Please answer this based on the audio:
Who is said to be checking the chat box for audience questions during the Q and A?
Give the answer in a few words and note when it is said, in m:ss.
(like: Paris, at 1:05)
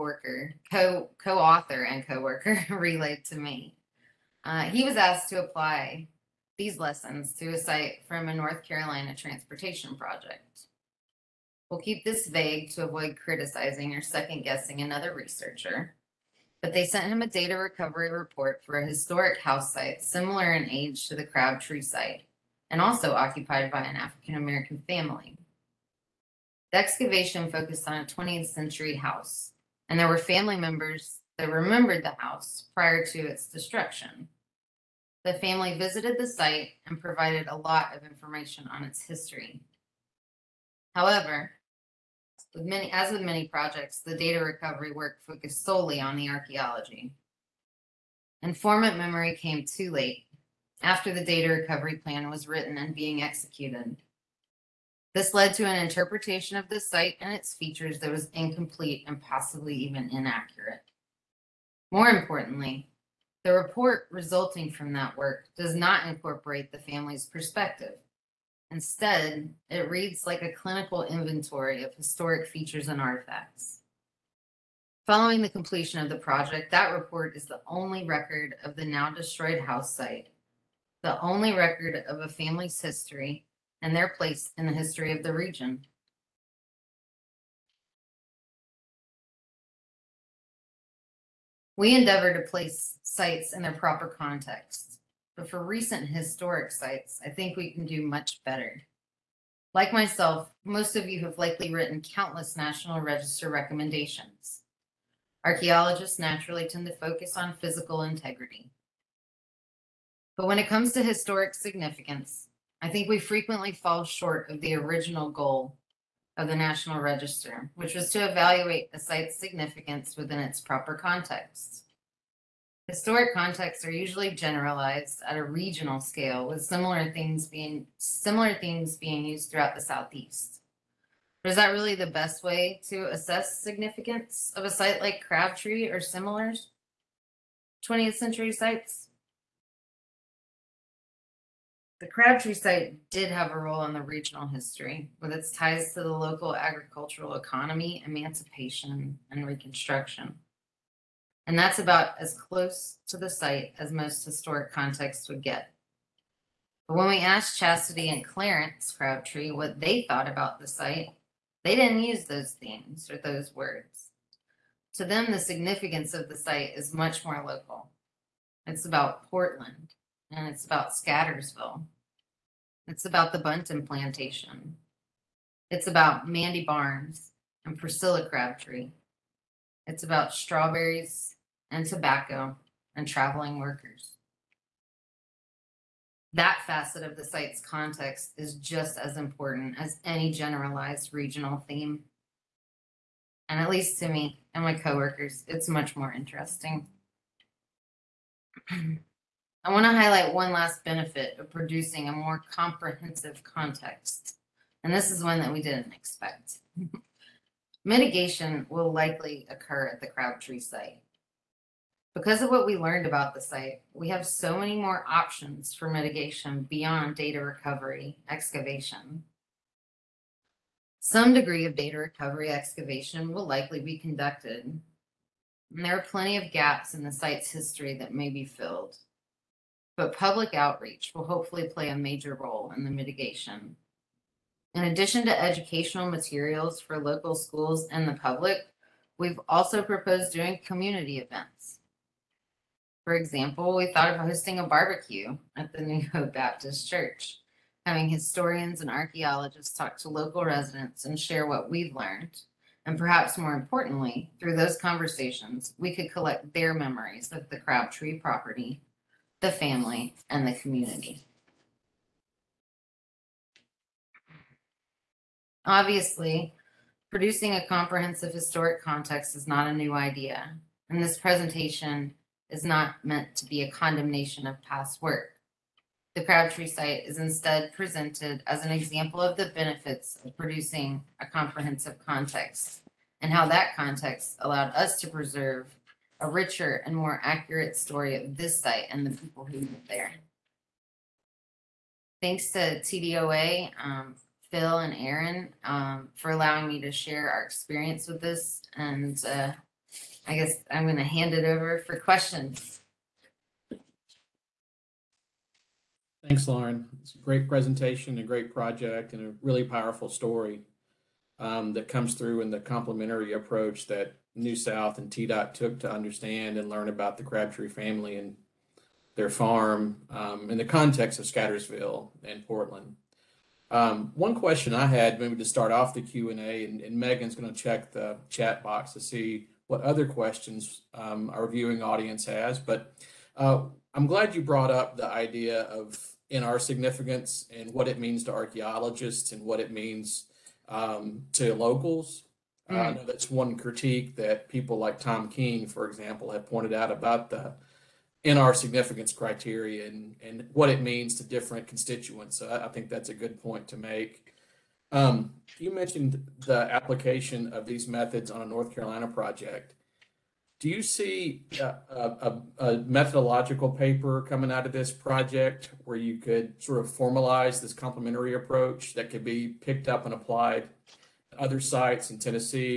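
Megan, at 5:26.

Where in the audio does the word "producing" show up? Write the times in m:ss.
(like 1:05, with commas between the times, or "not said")
3:21, 4:27, 4:40.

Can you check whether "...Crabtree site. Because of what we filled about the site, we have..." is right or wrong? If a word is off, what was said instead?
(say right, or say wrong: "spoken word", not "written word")
wrong: "learned", not "filled".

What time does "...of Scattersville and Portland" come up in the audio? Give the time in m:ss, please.
5:21.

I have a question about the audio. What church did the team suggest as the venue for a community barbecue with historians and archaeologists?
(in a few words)
New Hope Baptist Church.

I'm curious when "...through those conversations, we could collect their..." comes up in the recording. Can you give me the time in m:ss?
4:14.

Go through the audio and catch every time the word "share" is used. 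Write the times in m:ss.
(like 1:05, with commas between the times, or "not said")
4:11, 4:56.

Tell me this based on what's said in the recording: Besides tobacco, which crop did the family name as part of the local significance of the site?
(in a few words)
strawberries.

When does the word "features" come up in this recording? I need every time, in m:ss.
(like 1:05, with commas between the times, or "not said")
0:57, 1:12.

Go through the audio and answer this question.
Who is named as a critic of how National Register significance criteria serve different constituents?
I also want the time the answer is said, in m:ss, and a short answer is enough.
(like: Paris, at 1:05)
Tom King, at 5:44.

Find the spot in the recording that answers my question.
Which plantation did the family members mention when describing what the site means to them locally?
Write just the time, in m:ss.
2:53.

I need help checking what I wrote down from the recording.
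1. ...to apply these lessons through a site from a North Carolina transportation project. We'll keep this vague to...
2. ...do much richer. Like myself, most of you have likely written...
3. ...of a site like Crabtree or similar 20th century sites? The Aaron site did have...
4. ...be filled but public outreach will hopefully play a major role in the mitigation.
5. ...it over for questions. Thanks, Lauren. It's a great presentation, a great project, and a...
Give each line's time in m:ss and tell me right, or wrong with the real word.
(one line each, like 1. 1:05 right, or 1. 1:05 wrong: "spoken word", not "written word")
1. 0:05 right
2. 1:37 wrong: "better", not "richer"
3. 2:14 wrong: "Crabtree", not "Aaron"
4. 3:48 right
5. 5:01 right.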